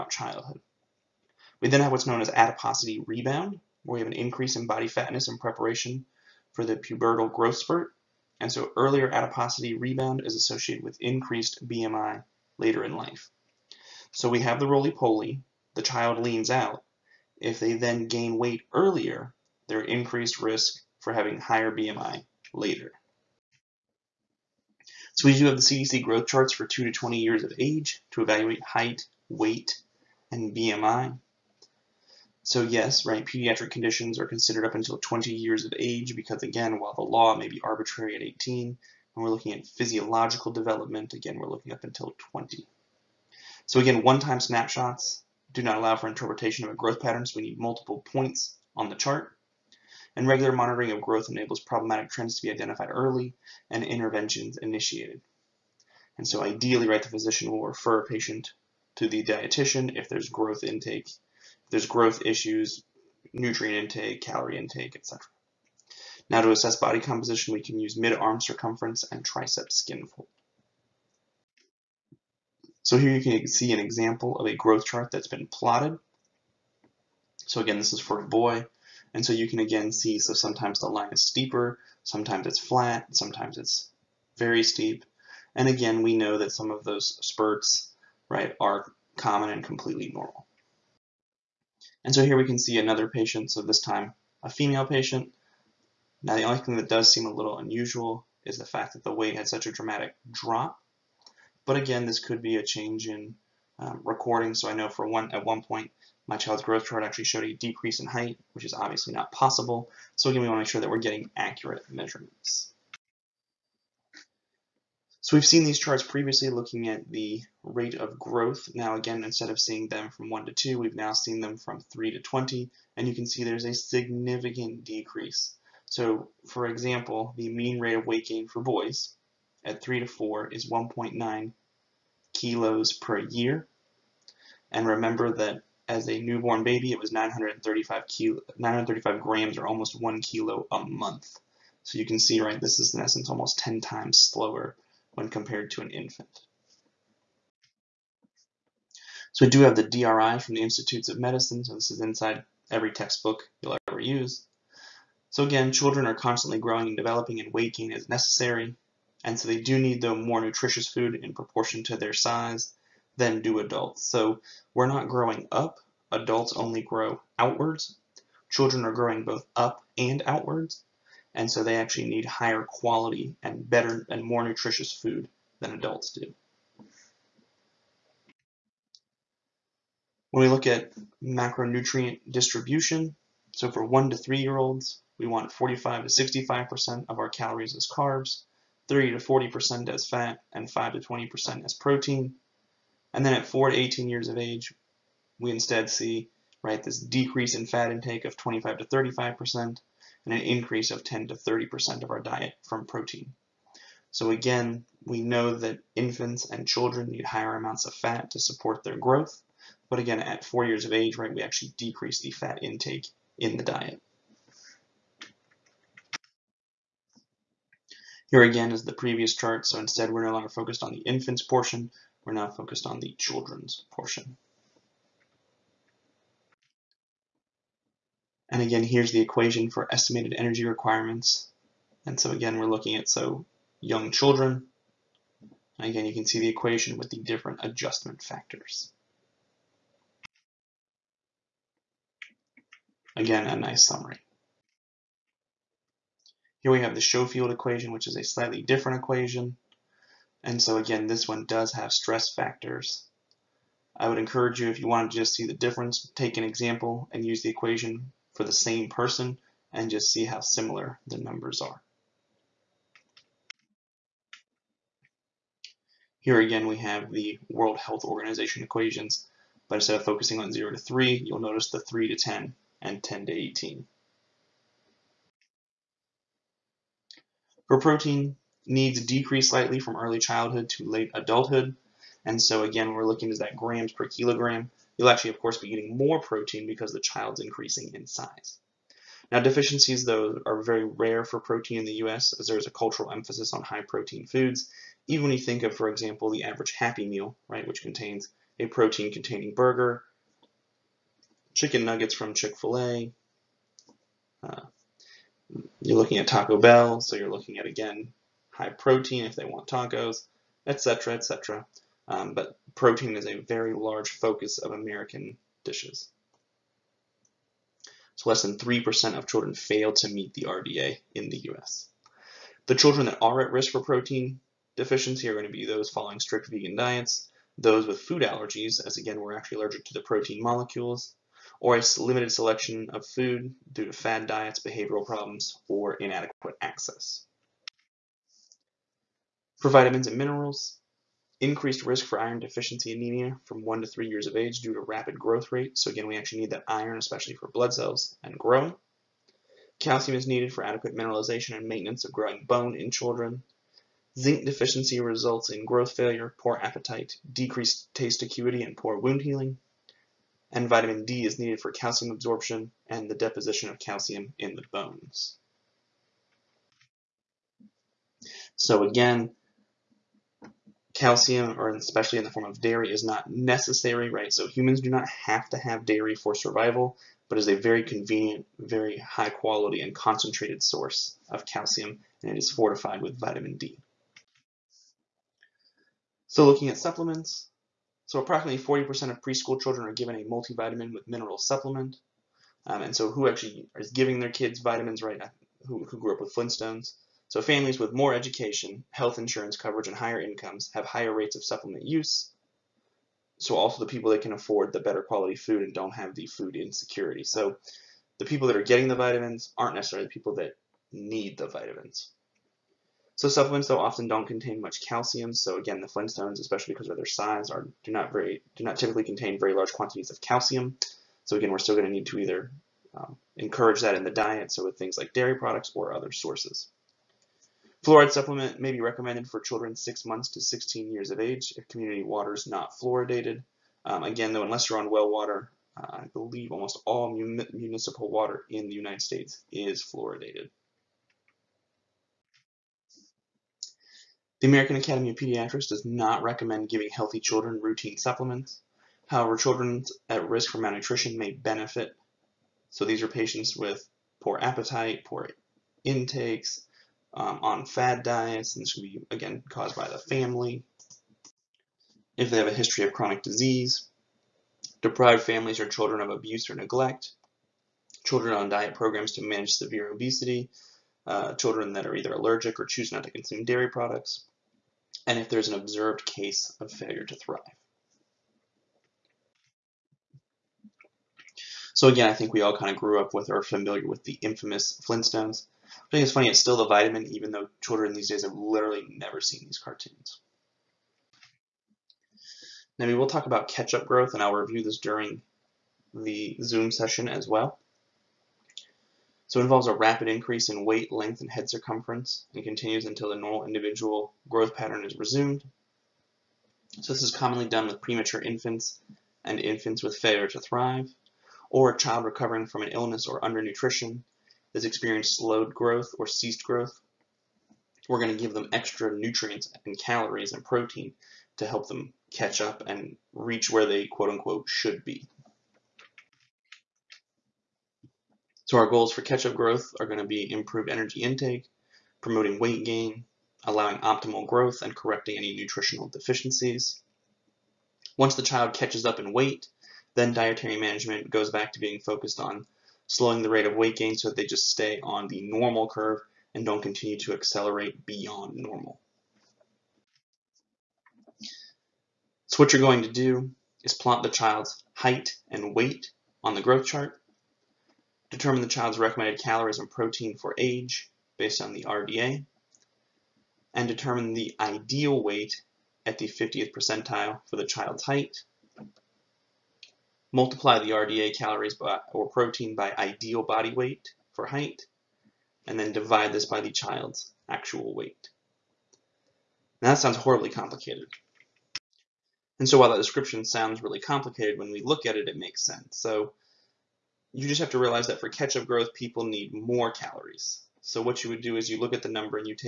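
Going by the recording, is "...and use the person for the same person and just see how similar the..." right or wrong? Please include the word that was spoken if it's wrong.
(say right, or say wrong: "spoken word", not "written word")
wrong: "equation", not "person".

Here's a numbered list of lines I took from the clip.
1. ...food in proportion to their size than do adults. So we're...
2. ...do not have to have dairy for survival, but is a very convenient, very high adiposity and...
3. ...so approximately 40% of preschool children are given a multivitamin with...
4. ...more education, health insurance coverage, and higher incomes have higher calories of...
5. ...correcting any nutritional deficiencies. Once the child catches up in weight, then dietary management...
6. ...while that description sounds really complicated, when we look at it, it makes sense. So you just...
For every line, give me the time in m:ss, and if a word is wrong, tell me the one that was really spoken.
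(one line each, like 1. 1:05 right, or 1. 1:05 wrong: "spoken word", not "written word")
1. 2:40 right
2. 6:14 wrong: "quality", not "adiposity"
3. 6:28 right
4. 6:37 wrong: "rates", not "calories"
5. 8:54 right
6. 9:42 right.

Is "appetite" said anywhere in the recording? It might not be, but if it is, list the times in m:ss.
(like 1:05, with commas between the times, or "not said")
5:56, 7:34.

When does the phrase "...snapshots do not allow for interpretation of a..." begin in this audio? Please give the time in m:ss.
0:44.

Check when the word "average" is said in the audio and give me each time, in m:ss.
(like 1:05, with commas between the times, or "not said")
4:56.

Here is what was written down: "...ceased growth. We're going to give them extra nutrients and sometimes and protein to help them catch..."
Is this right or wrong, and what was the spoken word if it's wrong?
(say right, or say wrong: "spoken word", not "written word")
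wrong: "calories", not "sometimes".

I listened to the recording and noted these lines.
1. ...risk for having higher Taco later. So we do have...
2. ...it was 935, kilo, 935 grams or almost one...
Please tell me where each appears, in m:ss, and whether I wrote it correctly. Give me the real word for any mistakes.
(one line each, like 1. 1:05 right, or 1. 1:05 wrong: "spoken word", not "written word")
1. 0:20 wrong: "BMI", not "Taco"
2. 2:16 right.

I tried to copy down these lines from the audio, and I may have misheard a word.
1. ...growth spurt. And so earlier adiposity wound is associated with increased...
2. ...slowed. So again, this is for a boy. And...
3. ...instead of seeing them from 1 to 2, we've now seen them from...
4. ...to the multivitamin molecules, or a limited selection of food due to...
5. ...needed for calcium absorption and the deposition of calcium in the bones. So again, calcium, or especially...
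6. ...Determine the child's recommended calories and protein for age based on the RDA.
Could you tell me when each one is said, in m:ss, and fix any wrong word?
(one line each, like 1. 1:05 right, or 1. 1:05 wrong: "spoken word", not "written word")
1. 0:07 wrong: "rebound", not "wound"
2. 1:15 wrong: "plotted", not "slowed"
3. 1:59 right
4. 5:29 wrong: "protein", not "multivitamin"
5. 6:01 right
6. 9:18 right.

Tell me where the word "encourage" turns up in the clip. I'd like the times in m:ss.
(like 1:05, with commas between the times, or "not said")
4:14, 7:03.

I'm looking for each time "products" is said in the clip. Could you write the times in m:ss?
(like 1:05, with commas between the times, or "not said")
7:05, 7:53.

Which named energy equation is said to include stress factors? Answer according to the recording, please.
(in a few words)
Schofield equation.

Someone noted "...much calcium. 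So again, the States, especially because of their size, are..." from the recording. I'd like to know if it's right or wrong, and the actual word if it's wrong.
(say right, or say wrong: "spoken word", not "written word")
wrong: "Flintstones", not "States".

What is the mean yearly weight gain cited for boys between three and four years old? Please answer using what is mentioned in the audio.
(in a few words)
1.9 kilos.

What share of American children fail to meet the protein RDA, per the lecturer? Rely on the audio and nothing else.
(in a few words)
less than 3%.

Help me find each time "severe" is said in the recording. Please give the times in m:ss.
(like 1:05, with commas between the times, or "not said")
7:49.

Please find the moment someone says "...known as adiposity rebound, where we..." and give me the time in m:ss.
0:02.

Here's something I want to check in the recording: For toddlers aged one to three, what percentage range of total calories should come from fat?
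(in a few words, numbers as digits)
30 to 40%.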